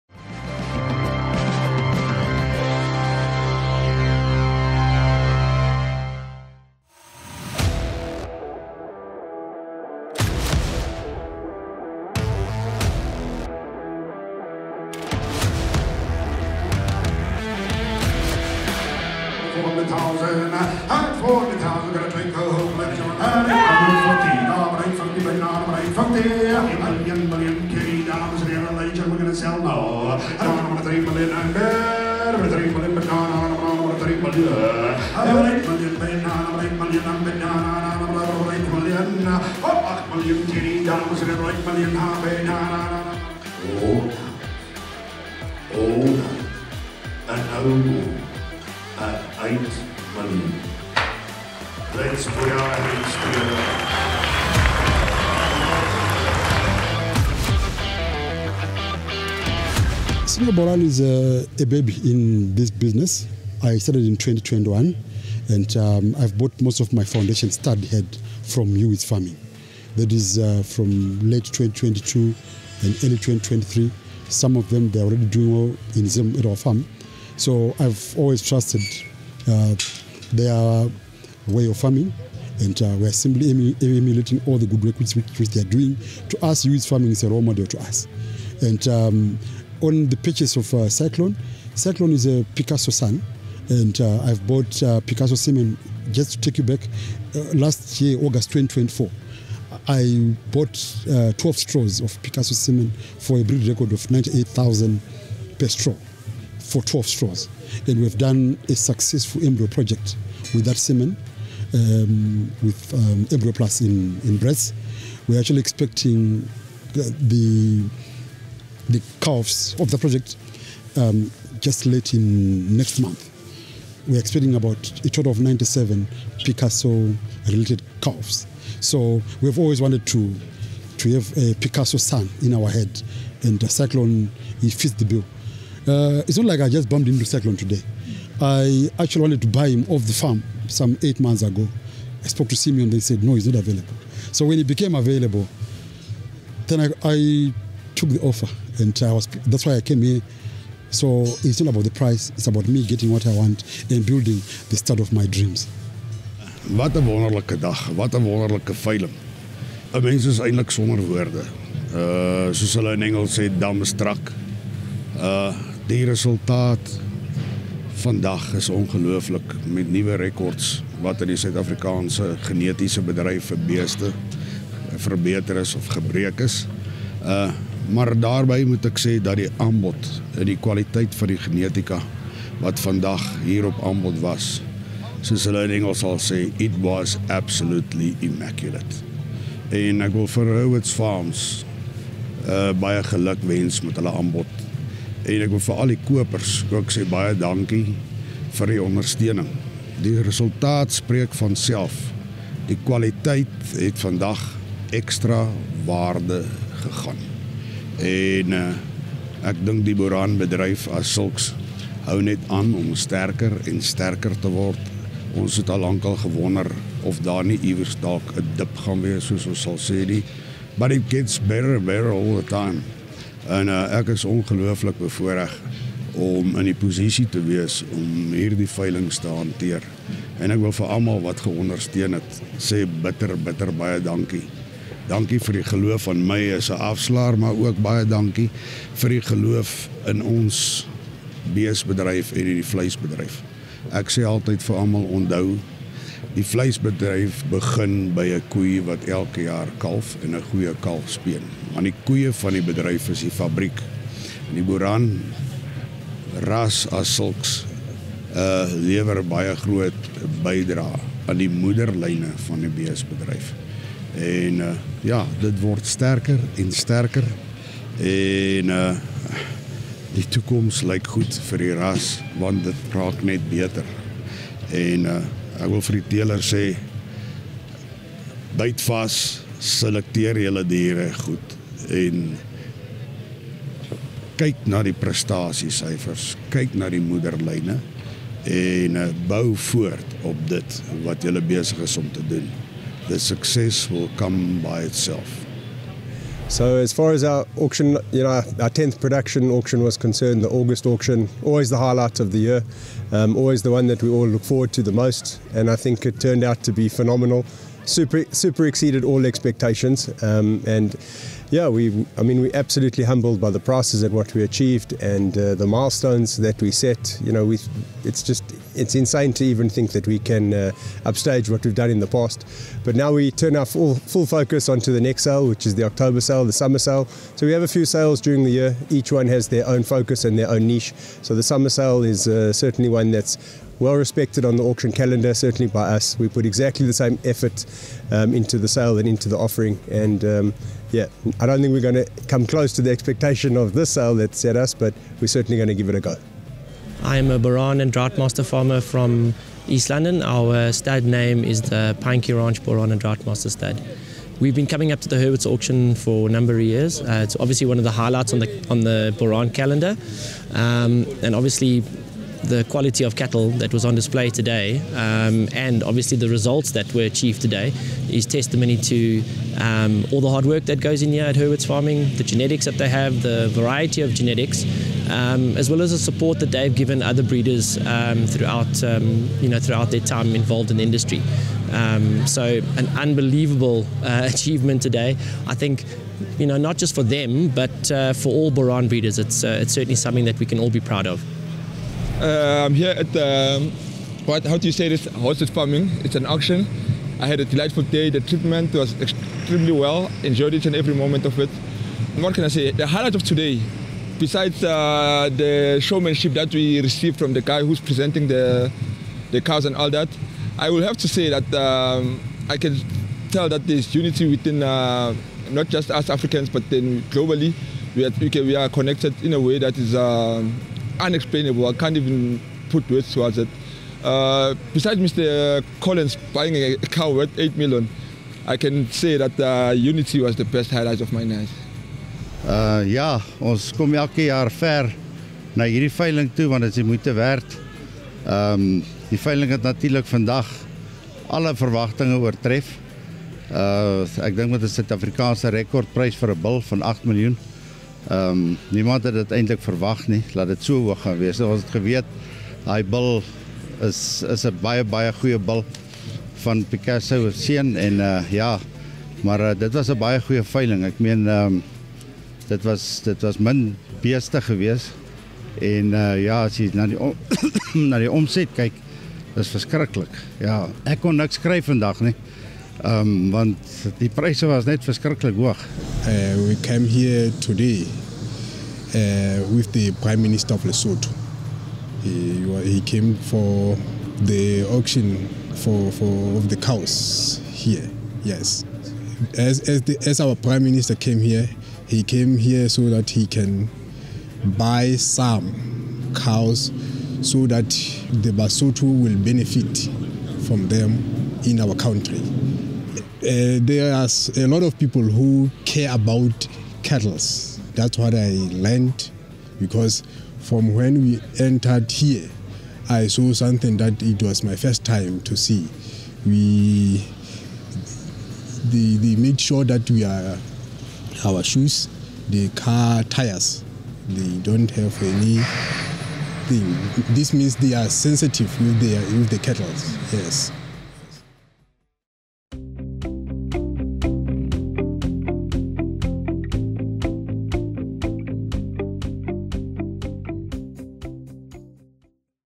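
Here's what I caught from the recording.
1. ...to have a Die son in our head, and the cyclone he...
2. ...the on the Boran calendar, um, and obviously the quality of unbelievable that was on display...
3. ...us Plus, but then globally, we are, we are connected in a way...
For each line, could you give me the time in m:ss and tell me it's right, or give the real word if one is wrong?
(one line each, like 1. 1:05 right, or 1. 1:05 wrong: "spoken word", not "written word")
1. 2:10 wrong: "Picasso", not "Die"
2. 5:58 wrong: "cattle", not "unbelievable"
3. 6:55 wrong: "Africans", not "Plus".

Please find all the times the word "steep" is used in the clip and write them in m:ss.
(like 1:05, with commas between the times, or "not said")
not said.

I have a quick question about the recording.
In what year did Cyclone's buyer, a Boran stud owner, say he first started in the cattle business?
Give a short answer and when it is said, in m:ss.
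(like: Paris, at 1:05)
2021, at 1:04.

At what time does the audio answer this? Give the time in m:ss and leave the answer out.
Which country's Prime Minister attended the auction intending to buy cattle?
8:00.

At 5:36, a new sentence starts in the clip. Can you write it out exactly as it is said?
We put exactly the same effort um, into the sale and into the offering.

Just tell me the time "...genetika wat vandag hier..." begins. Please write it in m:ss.
3:01.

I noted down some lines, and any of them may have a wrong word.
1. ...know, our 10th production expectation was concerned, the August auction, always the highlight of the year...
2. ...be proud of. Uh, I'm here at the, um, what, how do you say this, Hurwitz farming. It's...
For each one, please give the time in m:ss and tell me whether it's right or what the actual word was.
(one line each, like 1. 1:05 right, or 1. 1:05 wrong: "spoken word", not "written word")
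1. 4:58 wrong: "auction", not "expectation"
2. 6:30 right.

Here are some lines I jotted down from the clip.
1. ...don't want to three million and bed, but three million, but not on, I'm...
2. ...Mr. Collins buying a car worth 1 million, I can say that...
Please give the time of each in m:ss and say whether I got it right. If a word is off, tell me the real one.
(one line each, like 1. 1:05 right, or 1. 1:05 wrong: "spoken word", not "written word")
1. 0:30 right
2. 7:04 wrong: "8", not "1".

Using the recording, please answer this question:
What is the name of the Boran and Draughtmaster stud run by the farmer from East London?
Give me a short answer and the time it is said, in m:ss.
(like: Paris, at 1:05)
Pinekey Ranch, at 5:52.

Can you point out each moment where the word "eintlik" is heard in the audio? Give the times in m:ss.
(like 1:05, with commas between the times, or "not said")
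2:40, 7:29.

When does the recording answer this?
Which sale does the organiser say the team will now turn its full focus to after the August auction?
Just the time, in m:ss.
5:25.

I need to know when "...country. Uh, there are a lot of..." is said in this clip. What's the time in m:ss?
8:21.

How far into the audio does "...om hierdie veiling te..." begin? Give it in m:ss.
3:47.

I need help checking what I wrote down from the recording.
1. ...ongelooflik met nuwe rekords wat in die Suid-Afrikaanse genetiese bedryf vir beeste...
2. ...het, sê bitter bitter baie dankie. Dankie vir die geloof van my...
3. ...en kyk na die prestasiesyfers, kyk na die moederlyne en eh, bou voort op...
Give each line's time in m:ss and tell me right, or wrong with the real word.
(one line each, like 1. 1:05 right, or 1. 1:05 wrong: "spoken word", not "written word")
1. 2:48 right
2. 3:52 right
3. 4:41 right.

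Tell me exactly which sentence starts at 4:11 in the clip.
Maar die koeie van die bedryf is die fabriek.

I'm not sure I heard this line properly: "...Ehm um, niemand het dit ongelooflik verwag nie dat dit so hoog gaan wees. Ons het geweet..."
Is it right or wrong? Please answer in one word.
wrong.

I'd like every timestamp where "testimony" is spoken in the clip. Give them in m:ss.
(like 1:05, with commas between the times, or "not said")
6:08.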